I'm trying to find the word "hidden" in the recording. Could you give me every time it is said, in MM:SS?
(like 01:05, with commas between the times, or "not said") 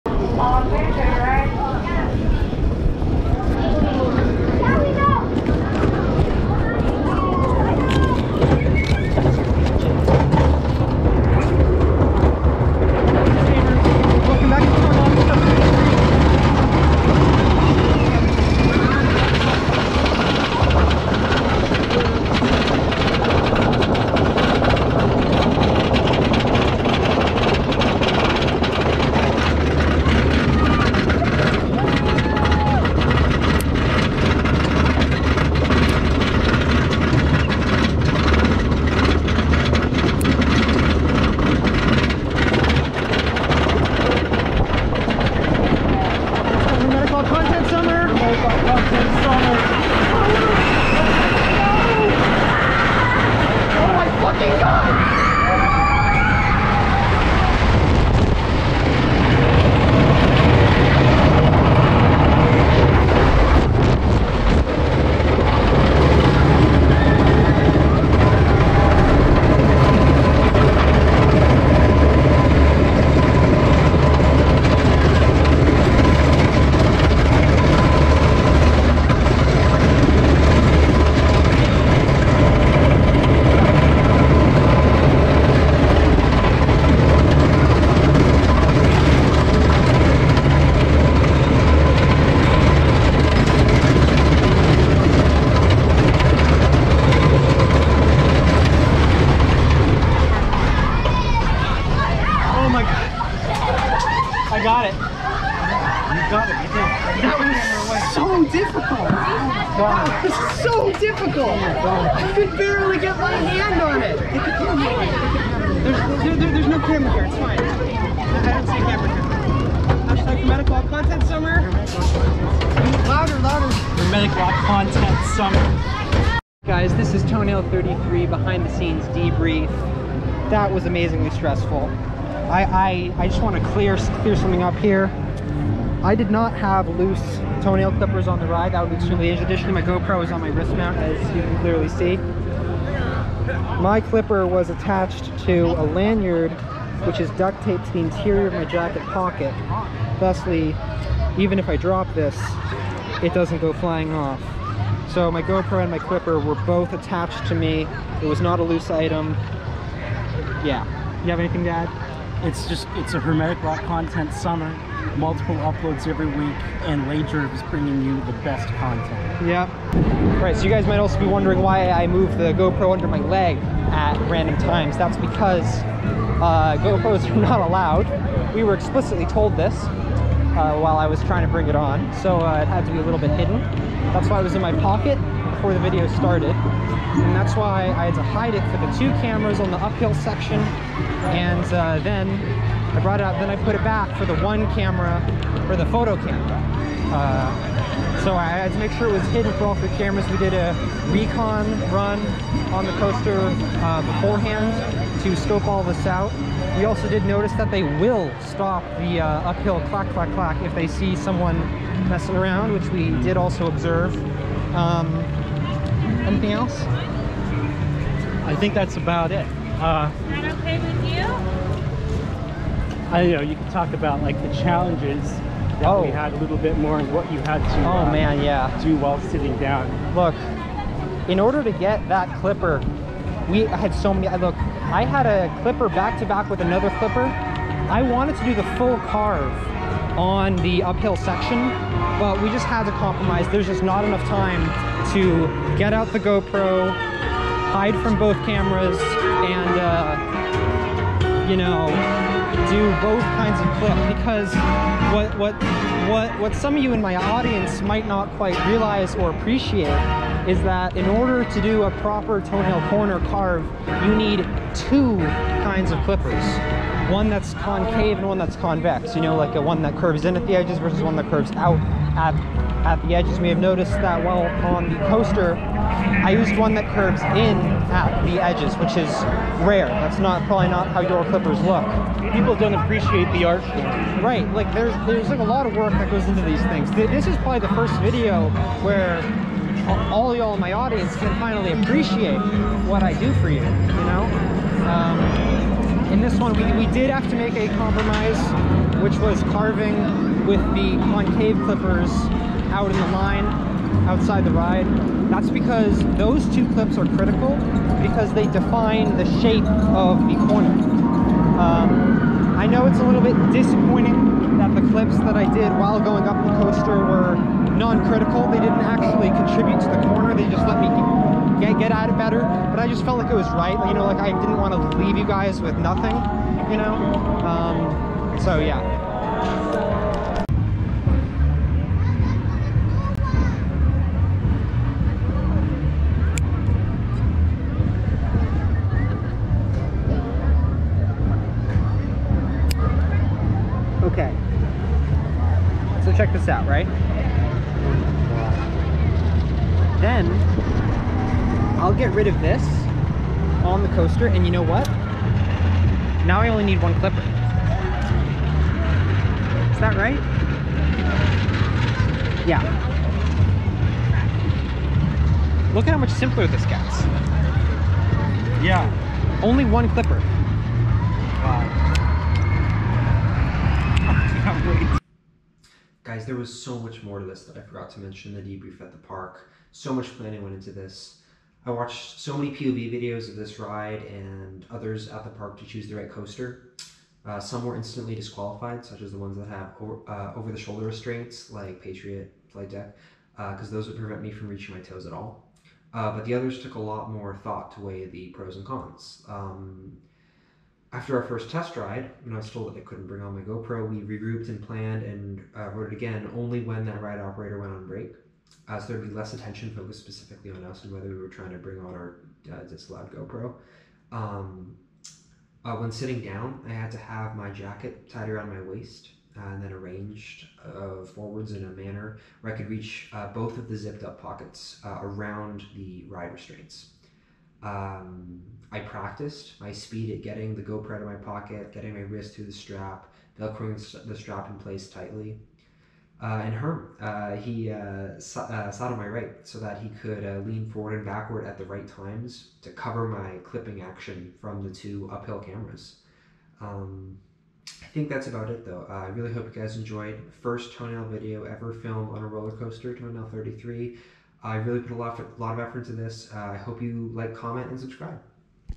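03:03, 03:19.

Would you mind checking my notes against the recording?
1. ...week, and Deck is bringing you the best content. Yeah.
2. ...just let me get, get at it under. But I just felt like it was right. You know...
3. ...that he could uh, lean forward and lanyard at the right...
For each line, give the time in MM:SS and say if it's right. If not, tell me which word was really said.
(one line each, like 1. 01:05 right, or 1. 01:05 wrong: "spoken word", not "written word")
1. 02:46 wrong: "Lager", not "Deck"
2. 05:20 wrong: "better", not "under"
3. 07:19 wrong: "backward", not "lanyard".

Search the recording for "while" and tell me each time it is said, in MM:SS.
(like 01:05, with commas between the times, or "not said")
03:00, 03:48, 04:34, 05:15.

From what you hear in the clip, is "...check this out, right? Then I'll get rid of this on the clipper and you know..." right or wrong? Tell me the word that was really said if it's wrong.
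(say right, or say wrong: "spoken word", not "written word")
wrong: "coaster", not "clipper".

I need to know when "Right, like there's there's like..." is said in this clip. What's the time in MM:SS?
04:44.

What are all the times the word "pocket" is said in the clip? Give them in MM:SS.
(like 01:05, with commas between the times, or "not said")
02:29, 03:04, 07:04, 07:11.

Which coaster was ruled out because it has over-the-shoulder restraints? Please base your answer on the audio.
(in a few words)
Patriot.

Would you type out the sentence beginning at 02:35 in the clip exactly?
So my GoPro and my clipper were both attached to me.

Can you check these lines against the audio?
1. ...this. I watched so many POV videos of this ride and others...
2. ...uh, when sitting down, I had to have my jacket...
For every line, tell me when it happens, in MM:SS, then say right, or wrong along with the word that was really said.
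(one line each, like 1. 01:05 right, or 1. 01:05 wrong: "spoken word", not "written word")
1. 06:20 right
2. 06:55 right.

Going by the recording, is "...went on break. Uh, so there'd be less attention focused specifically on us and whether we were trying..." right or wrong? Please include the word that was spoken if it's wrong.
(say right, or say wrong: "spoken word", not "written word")
right.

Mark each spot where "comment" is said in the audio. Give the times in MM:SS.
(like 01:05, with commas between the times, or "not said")
07:37.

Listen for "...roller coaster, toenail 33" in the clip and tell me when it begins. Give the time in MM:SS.
07:32.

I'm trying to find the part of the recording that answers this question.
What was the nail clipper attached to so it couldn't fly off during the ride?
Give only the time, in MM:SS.
02:25.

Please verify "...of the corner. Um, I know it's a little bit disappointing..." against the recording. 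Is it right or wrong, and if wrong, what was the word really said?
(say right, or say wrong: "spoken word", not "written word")
right.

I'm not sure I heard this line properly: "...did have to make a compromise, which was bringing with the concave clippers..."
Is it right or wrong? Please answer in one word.
wrong.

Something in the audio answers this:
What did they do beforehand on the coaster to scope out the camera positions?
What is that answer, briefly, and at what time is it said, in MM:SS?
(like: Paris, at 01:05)
A recon run, at 03:21.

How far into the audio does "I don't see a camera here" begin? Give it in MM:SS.
01:57.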